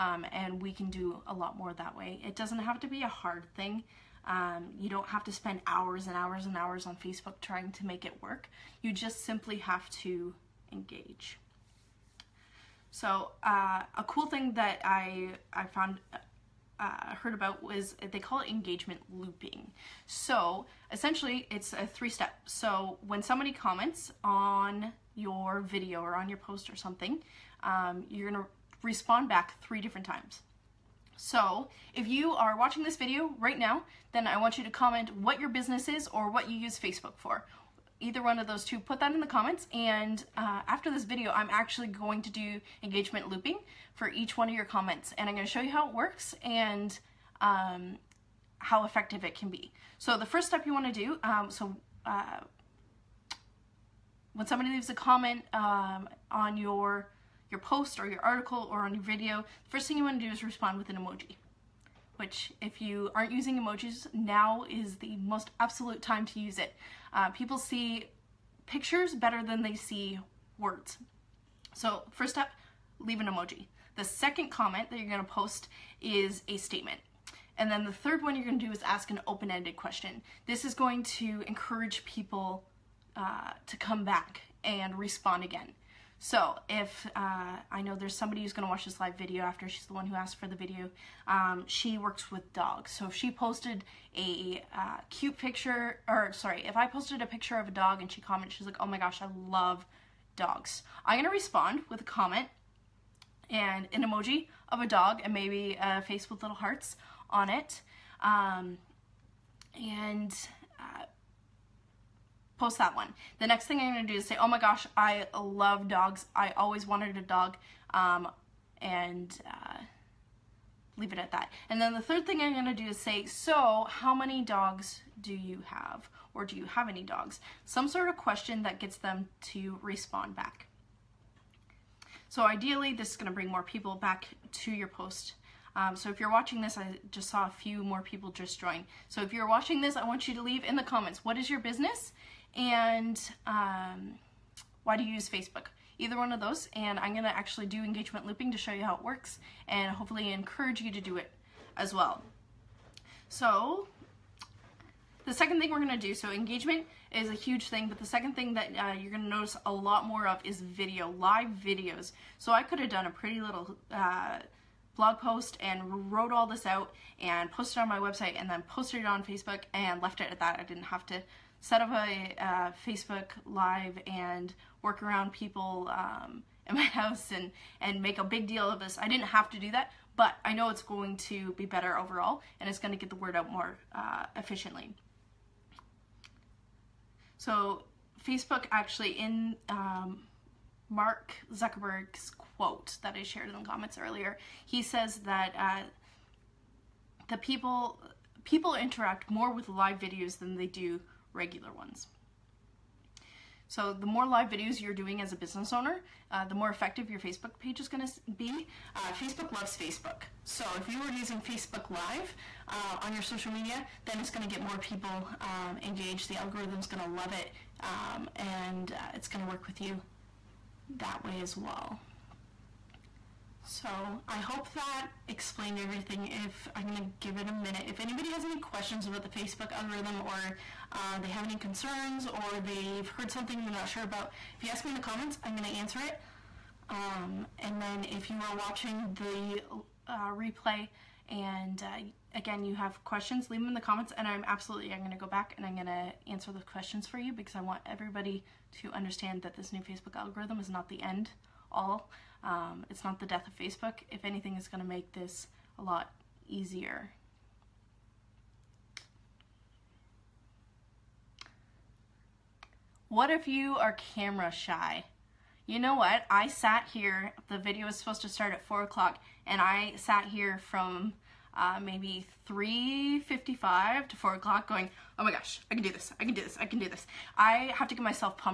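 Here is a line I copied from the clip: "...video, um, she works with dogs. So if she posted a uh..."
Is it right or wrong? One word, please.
right.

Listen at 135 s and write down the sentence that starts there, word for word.
Um, so if you're watching this, I just saw a few more people just join.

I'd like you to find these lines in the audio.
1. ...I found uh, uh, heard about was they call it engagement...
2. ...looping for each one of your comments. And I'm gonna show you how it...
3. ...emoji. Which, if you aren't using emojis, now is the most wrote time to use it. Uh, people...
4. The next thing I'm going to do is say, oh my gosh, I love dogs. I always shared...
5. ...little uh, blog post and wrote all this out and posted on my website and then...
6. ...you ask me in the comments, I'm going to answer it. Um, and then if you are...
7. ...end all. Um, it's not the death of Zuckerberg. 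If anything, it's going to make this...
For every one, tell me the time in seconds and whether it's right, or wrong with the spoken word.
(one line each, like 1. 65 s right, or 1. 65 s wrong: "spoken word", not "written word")
1. 15 s right
2. 43 s right
3. 60 s wrong: "absolute", not "wrote"
4. 113 s wrong: "wanted", not "shared"
5. 163 s right
6. 234 s right
7. 251 s wrong: "Facebook", not "Zuckerberg".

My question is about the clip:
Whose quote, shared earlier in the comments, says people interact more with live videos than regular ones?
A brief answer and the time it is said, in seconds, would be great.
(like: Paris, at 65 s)
Mark Zuckerberg, at 190 s.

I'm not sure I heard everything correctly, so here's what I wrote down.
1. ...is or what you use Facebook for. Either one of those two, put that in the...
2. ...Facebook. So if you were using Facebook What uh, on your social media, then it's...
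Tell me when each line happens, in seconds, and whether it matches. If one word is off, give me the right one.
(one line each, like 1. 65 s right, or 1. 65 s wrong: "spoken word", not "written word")
1. 35 s right
2. 209 s wrong: "Live", not "What".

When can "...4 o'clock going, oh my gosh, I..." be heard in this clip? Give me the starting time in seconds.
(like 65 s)
274 s.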